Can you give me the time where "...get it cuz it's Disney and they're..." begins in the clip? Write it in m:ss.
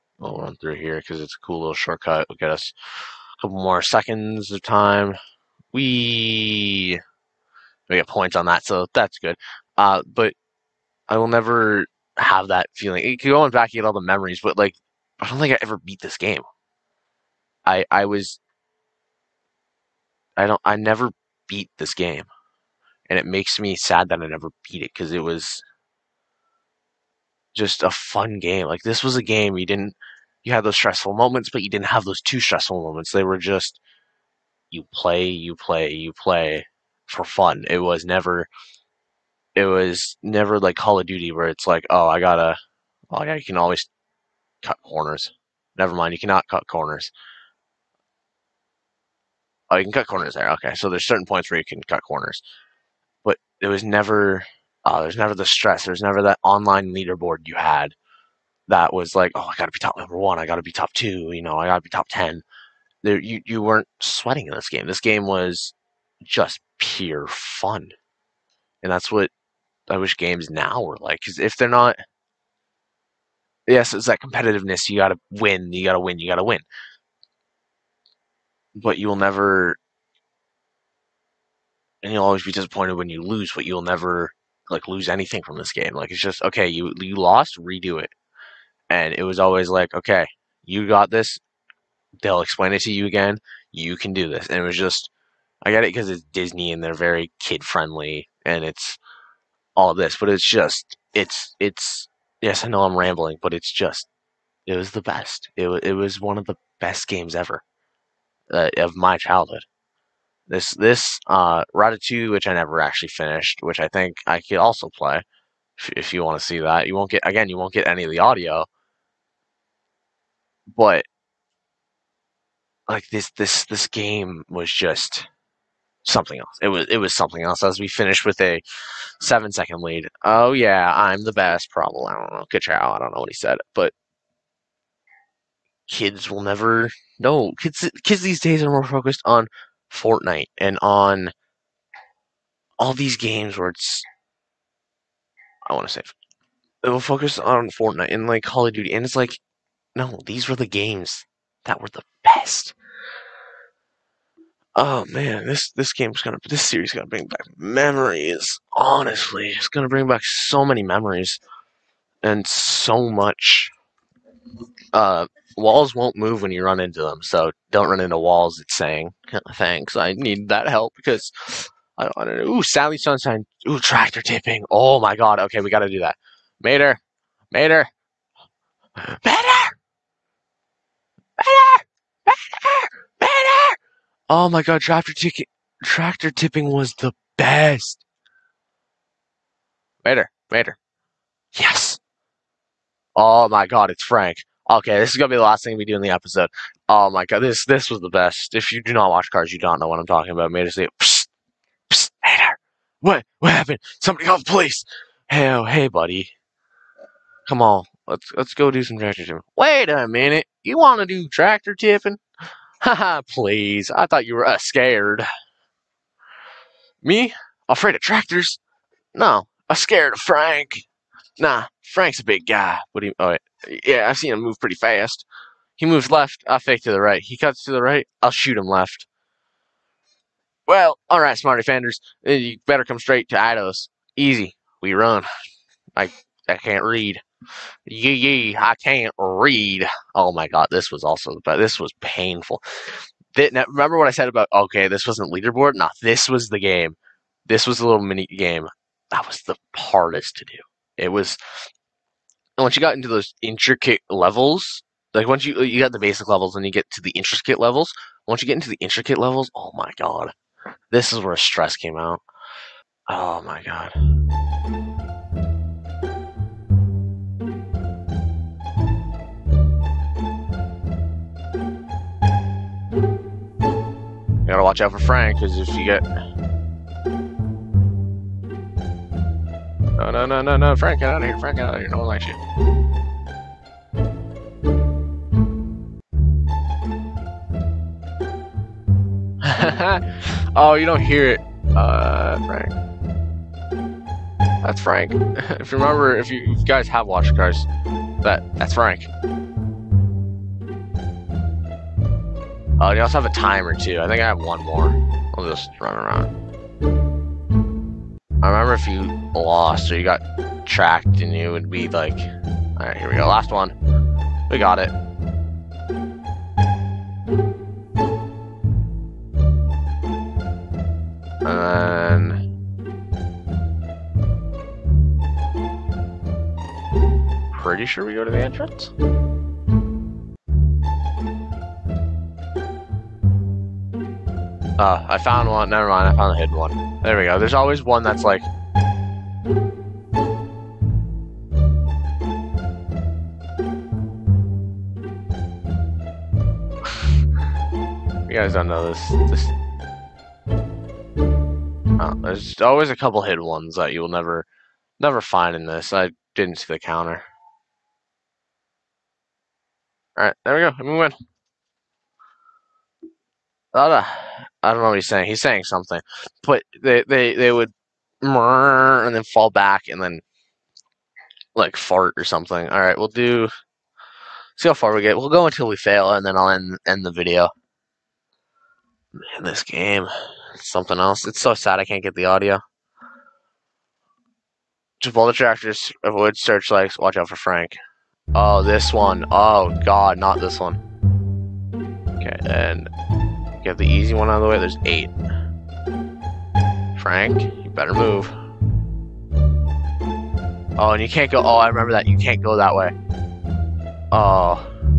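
1:35.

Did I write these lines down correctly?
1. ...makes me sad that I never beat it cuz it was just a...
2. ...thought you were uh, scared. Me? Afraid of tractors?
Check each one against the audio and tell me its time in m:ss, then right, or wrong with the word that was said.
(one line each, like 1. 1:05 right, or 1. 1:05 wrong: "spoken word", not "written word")
1. 0:23 right
2. 3:34 right.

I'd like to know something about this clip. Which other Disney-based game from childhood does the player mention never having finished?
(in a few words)
Ratatouille.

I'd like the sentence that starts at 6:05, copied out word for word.
He's saying something, but they they they would and then fall back and then like fart or something.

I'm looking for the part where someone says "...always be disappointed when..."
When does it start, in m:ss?
1:22.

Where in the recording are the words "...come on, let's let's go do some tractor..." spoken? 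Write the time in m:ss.
3:27.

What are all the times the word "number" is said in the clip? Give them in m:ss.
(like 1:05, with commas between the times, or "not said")
0:59.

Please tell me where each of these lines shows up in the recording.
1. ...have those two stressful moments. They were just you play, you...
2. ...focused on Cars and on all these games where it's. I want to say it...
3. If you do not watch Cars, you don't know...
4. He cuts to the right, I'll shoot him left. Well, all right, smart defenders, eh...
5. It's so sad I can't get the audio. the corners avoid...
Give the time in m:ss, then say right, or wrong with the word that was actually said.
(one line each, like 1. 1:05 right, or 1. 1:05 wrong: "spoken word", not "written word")
1. 0:31 right
2. 2:18 wrong: "Fortnite", not "Cars"
3. 3:18 right
4. 3:47 right
5. 6:21 wrong: "tractors", not "corners".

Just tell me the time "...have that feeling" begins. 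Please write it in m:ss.
0:12.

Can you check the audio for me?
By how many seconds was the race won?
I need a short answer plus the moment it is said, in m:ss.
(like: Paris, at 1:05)
7, at 2:09.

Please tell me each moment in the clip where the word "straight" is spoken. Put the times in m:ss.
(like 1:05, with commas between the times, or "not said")
3:52.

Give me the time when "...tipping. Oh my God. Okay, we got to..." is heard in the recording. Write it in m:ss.
2:54.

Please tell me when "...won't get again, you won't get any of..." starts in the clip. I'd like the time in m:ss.
1:56.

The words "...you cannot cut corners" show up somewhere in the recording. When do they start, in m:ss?
0:46.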